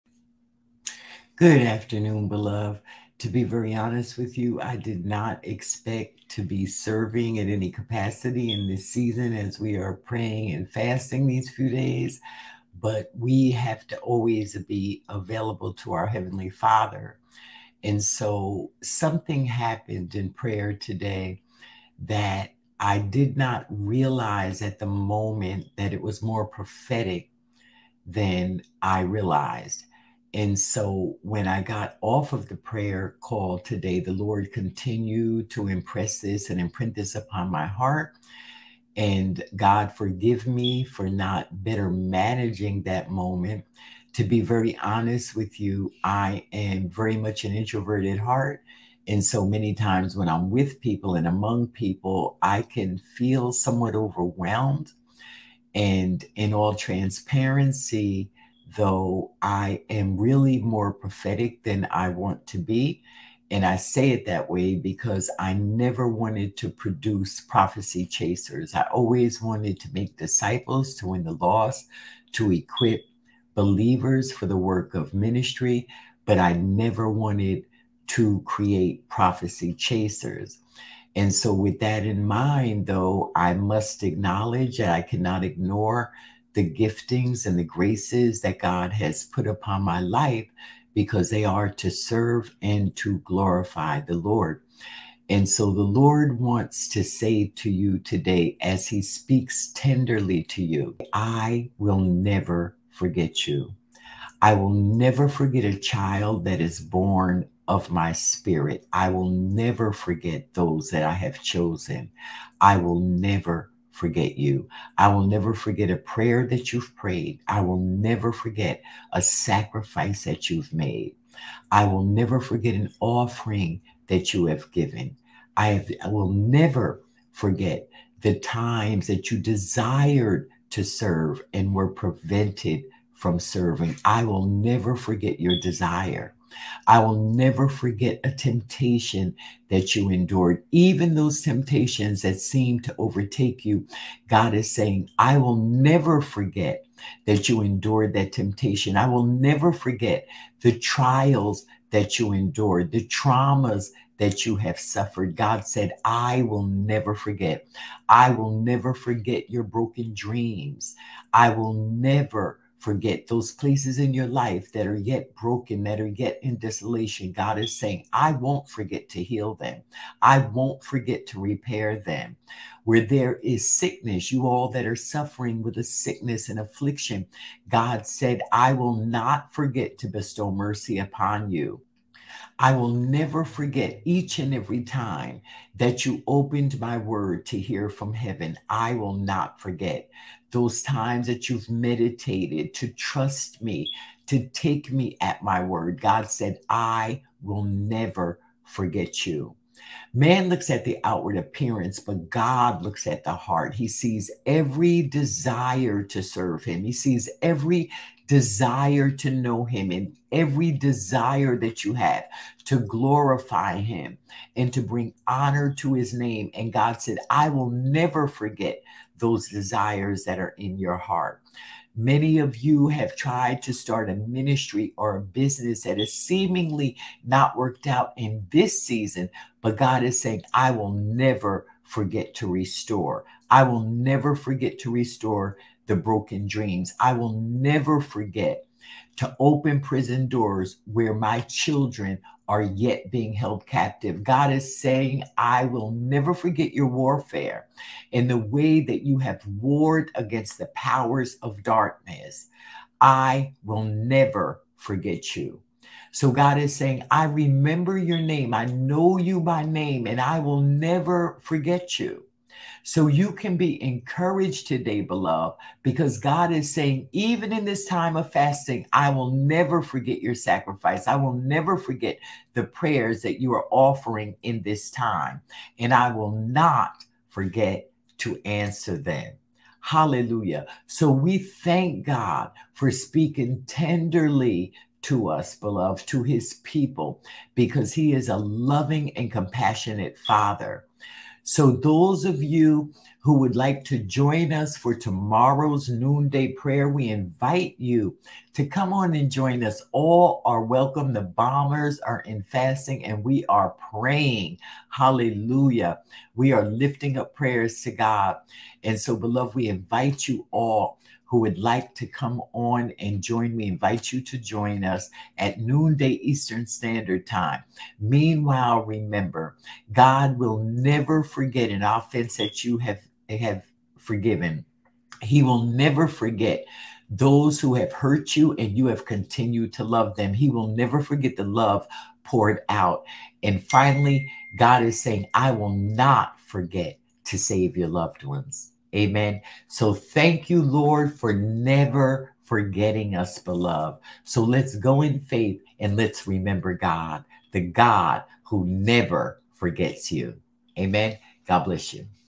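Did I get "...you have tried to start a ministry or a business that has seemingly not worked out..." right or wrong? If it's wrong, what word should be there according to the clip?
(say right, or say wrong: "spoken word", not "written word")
right.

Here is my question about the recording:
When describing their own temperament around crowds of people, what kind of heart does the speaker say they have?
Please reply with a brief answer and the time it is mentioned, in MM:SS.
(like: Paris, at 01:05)
introverted heart, at 00:47.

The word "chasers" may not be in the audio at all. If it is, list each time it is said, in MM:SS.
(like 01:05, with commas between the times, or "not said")
01:08, 01:19.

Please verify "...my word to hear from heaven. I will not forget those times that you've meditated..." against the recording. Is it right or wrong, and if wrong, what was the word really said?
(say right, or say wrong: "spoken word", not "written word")
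right.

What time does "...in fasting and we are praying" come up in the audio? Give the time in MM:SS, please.
05:02.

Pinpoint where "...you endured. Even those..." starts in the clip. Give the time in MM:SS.
02:19.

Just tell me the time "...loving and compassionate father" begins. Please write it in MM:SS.
04:48.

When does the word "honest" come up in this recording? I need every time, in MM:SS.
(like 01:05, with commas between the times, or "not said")
00:03, 00:44.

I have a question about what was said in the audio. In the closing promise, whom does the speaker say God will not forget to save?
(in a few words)
your loved ones.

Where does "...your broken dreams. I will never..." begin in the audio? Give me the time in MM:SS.
02:39.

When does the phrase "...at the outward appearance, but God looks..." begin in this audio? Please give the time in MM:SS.
03:20.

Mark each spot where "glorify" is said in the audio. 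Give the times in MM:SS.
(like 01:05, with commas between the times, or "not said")
01:33, 03:32.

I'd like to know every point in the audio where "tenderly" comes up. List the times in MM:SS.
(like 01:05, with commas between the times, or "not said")
01:39, 04:43.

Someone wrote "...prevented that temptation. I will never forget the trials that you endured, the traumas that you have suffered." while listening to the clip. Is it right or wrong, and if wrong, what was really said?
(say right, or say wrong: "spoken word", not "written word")
wrong: "endured", not "prevented".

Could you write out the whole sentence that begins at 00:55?
And in all transparency, though I am really more prophetic than I want to be.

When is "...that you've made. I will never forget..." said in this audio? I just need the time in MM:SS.
02:00.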